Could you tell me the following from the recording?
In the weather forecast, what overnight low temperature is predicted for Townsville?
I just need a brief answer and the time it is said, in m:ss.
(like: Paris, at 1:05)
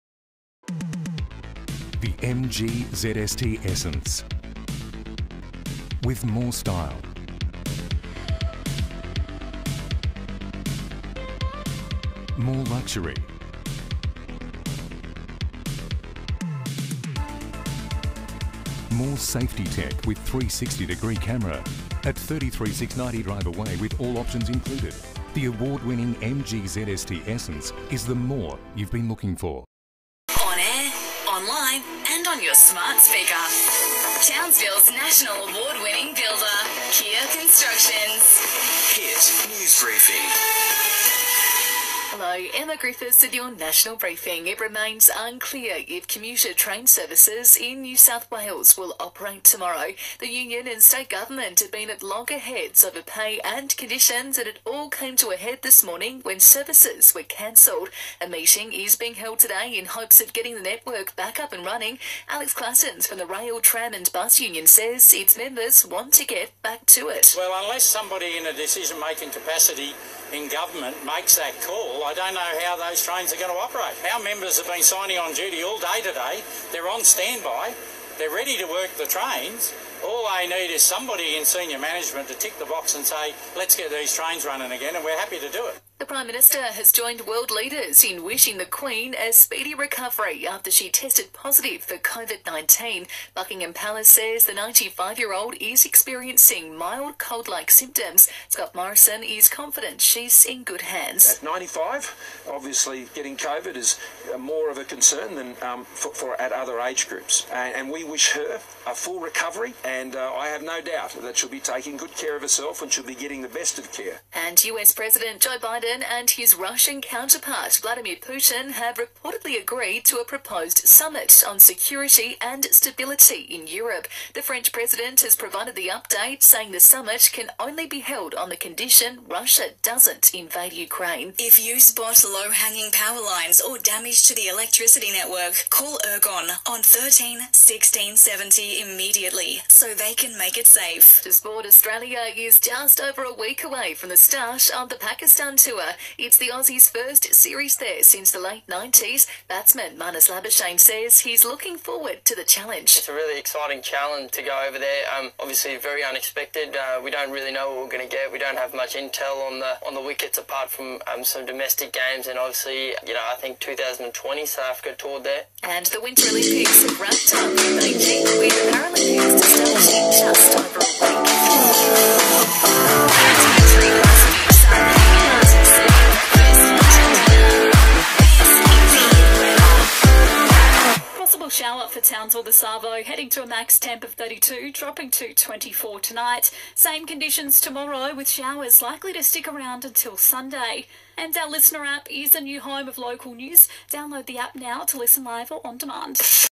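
24, at 3:05.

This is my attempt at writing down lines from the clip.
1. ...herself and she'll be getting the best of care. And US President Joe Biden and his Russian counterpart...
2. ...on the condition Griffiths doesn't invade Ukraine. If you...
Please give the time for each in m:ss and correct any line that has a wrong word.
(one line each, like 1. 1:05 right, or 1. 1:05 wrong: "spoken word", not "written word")
1. 1:52 right
2. 2:08 wrong: "Russia", not "Griffiths".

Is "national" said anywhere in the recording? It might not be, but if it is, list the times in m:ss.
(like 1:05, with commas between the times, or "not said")
0:34, 0:43.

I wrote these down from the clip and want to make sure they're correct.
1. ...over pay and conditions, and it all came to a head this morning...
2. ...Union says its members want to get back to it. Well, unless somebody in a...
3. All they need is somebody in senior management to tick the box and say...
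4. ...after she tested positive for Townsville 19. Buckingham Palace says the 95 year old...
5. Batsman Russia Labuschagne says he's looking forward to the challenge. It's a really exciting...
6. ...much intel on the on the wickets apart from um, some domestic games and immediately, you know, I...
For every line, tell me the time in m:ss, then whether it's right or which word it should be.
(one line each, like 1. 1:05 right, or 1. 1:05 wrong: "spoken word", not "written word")
1. 0:52 right
2. 1:04 right
3. 1:20 right
4. 1:30 wrong: "COVID", not "Townsville"
5. 2:29 wrong: "Marnus", not "Russia"
6. 2:38 wrong: "obviously", not "immediately".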